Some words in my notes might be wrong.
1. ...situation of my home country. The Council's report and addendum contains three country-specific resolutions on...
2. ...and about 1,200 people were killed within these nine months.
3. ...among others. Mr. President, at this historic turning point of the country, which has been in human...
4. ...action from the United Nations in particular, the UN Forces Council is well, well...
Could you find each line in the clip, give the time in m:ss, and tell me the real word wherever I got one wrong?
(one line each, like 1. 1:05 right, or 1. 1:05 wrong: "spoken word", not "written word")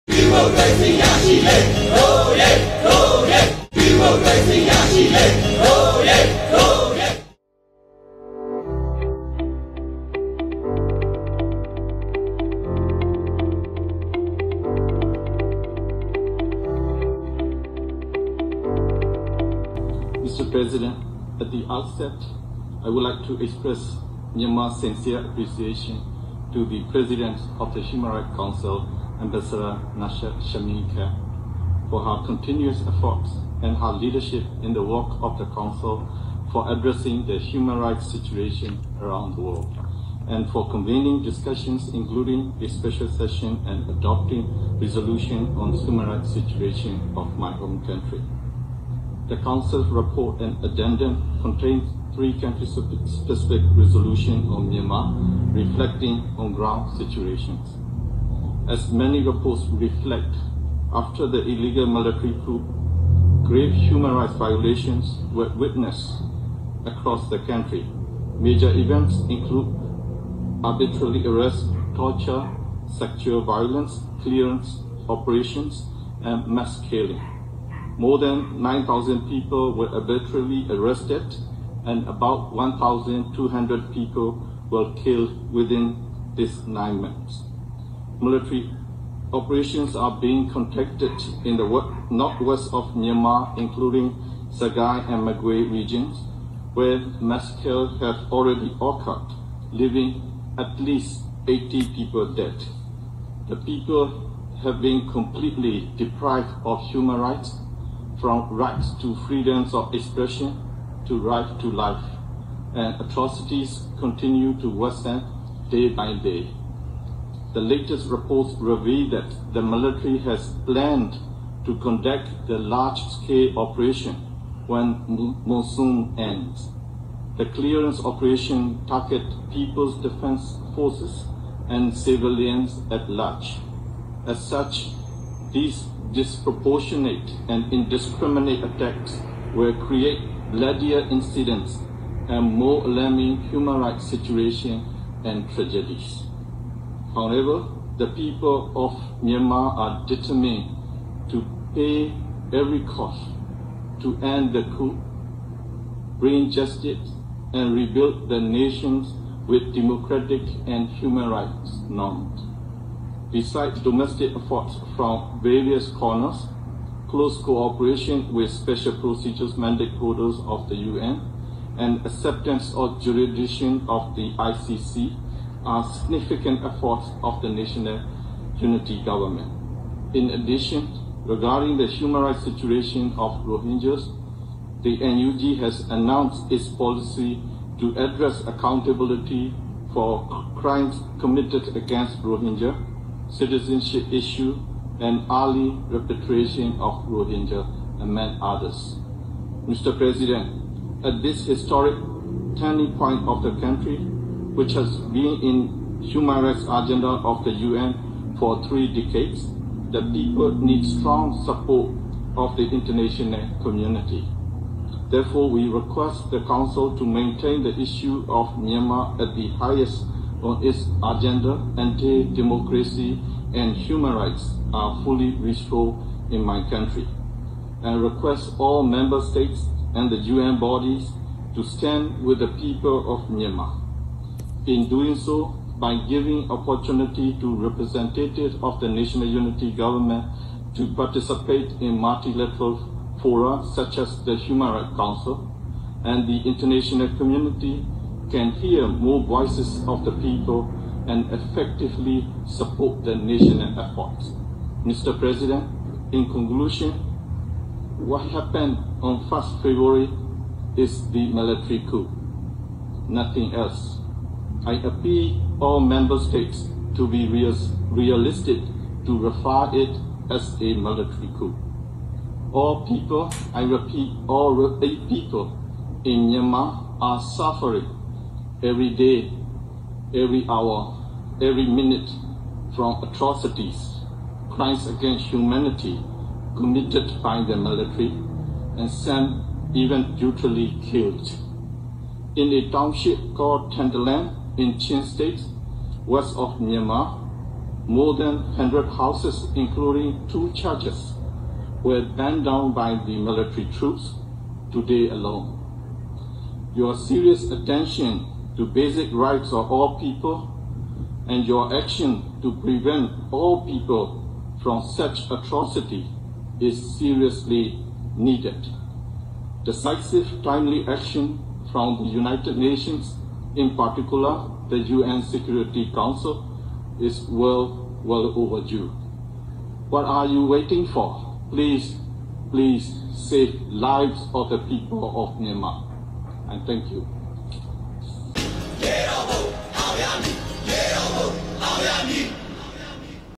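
1. 0:46 right
2. 1:21 right
3. 3:18 right
4. 5:20 wrong: "Security", not "Forces".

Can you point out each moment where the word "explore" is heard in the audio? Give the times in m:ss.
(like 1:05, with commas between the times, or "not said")
not said.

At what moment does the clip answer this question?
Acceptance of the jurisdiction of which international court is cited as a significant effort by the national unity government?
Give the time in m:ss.
2:54.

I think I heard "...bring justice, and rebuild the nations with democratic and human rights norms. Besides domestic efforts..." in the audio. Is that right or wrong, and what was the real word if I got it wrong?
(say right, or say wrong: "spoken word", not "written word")
right.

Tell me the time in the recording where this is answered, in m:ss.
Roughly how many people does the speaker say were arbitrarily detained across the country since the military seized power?
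1:18.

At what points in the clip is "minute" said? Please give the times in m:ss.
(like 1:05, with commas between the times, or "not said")
4:41.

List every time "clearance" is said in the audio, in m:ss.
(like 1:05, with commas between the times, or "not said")
1:14, 2:07.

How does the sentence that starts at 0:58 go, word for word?
As many reports reflect after the illegal military coup, grave human rights violations were witnessed across the country.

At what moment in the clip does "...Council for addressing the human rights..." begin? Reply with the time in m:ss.
0:35.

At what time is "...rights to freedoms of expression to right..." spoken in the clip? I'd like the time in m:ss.
1:48.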